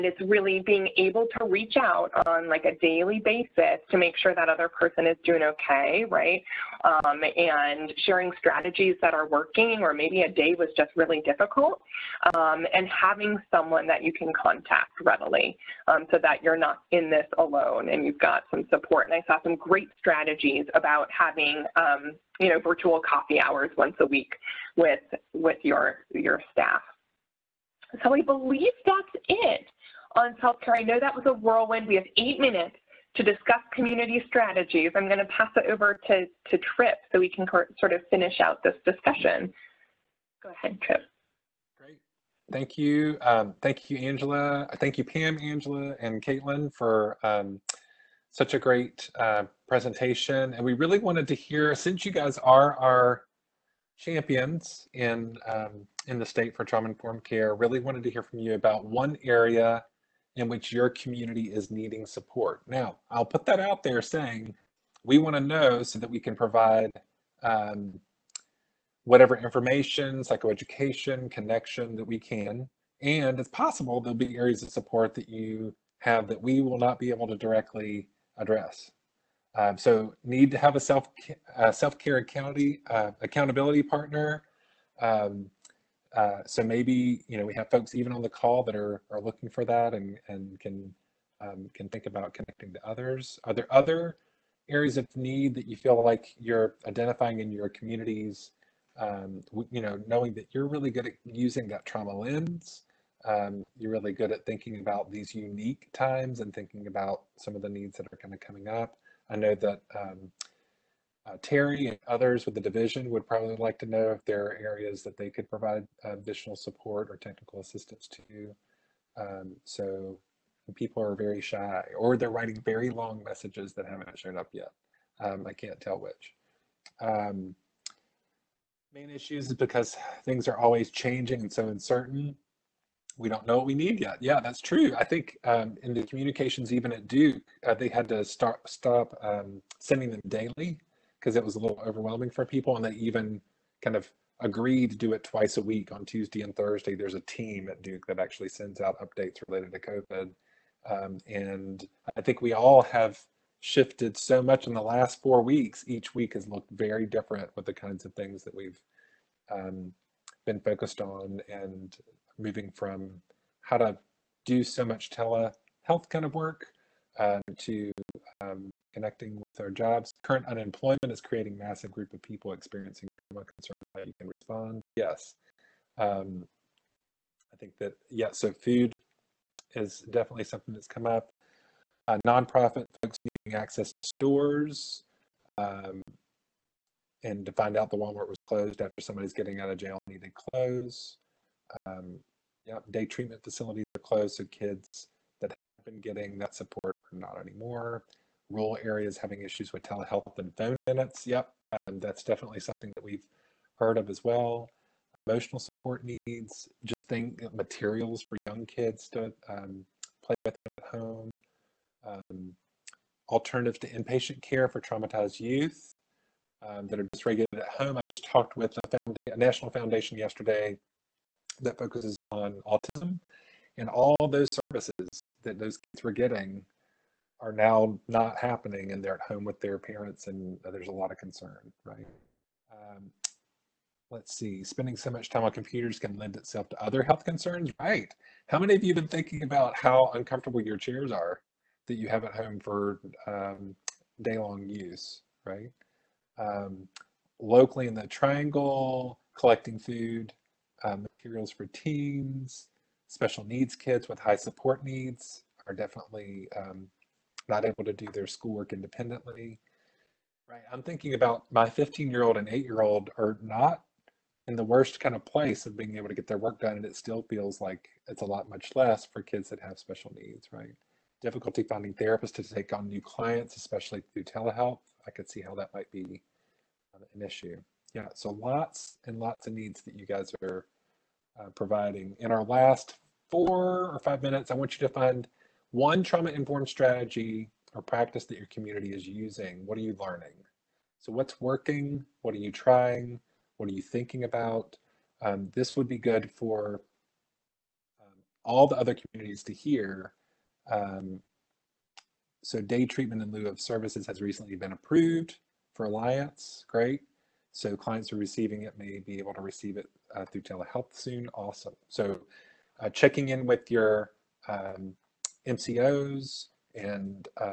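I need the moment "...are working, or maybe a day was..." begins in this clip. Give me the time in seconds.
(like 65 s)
9 s.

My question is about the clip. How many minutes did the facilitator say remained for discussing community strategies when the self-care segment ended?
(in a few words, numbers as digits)
8.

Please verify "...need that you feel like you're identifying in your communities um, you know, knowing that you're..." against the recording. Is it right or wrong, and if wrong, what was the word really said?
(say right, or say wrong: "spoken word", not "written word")
right.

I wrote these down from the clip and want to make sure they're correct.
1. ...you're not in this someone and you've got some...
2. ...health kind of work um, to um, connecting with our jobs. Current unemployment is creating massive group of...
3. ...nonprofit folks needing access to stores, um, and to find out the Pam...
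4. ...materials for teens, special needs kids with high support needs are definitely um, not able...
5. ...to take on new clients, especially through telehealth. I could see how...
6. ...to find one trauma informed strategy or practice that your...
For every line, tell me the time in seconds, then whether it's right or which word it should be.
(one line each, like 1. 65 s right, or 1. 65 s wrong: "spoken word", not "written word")
1. 16 s wrong: "alone", not "someone"
2. 165 s wrong: "telehealth", not "health"
3. 182 s wrong: "Walmart", not "Pam"
4. 250 s right
5. 272 s right
6. 284 s right.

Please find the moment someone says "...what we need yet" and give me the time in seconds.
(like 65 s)
133 s.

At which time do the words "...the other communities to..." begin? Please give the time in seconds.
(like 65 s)
298 s.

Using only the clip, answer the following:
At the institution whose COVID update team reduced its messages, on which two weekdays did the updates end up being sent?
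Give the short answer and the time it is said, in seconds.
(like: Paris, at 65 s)
Tuesday and Thursday, at 146 s.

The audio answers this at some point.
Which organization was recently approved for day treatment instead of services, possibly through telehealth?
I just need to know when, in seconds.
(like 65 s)
305 s.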